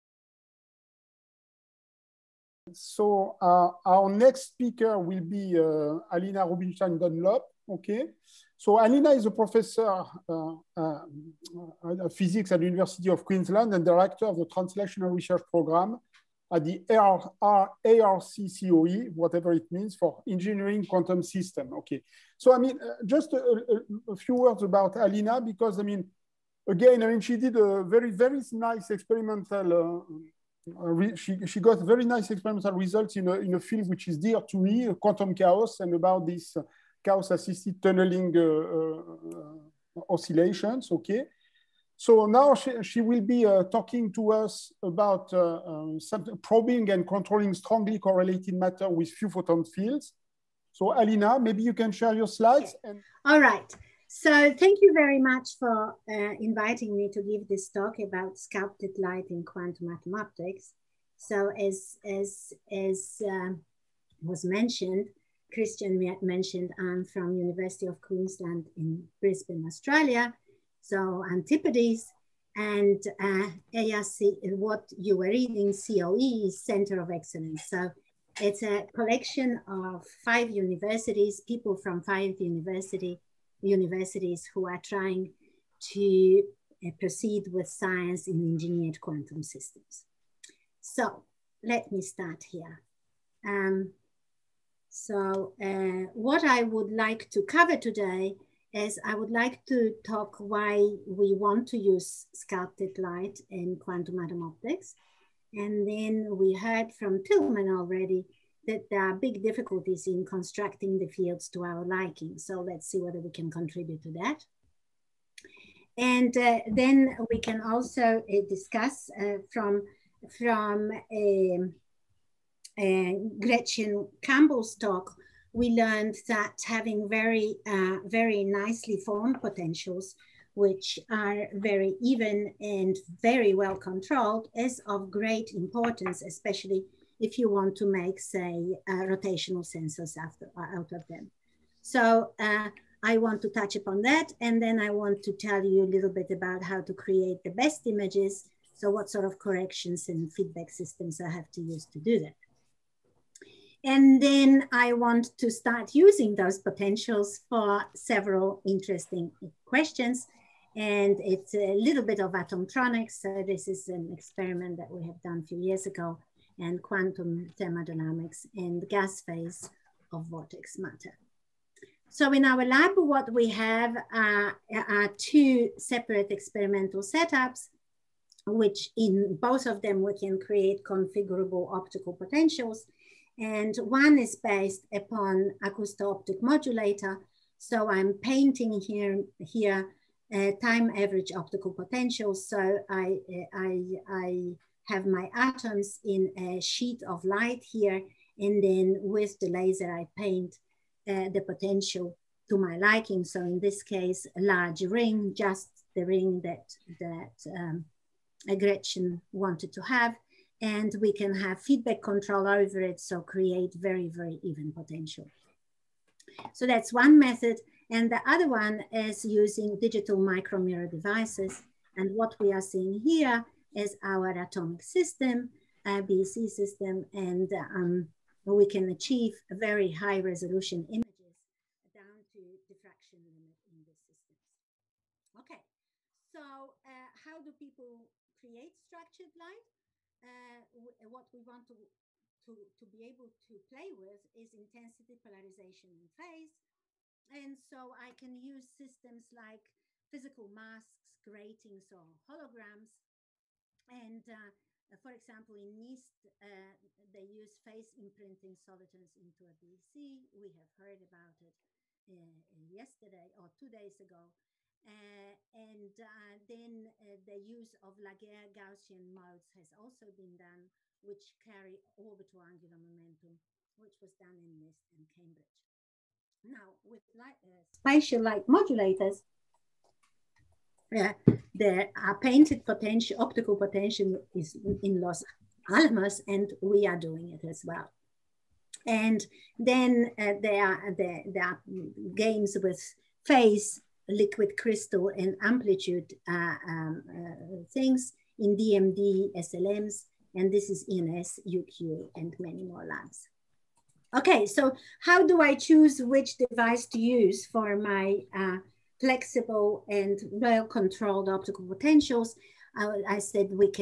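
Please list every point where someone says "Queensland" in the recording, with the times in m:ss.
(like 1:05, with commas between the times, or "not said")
0:13, 1:08.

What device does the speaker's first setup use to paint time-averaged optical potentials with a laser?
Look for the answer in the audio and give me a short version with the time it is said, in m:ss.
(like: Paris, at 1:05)
acousto-optic modulator, at 3:05.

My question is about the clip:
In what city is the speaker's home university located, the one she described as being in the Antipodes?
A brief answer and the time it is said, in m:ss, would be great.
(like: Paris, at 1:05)
Brisbane, at 1:09.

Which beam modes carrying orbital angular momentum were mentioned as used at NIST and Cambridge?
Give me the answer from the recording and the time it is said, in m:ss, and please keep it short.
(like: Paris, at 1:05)
Laguerre Gaussian modes, at 4:27.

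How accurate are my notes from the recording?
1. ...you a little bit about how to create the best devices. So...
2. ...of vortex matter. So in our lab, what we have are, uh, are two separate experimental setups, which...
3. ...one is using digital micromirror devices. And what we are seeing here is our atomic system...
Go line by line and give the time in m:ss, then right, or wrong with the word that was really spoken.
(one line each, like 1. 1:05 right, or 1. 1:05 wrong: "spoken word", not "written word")
1. 2:25 wrong: "images", not "devices"
2. 2:50 right
3. 3:38 right.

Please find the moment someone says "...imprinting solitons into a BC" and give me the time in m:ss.
4:17.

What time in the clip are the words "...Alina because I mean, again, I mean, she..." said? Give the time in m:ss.
0:24.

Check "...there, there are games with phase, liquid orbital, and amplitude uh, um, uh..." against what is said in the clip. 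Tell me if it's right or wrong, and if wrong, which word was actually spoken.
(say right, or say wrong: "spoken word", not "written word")
wrong: "crystal", not "orbital".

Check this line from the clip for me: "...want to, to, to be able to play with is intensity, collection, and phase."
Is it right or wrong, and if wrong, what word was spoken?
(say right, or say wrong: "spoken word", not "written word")
wrong: "polarization", not "collection".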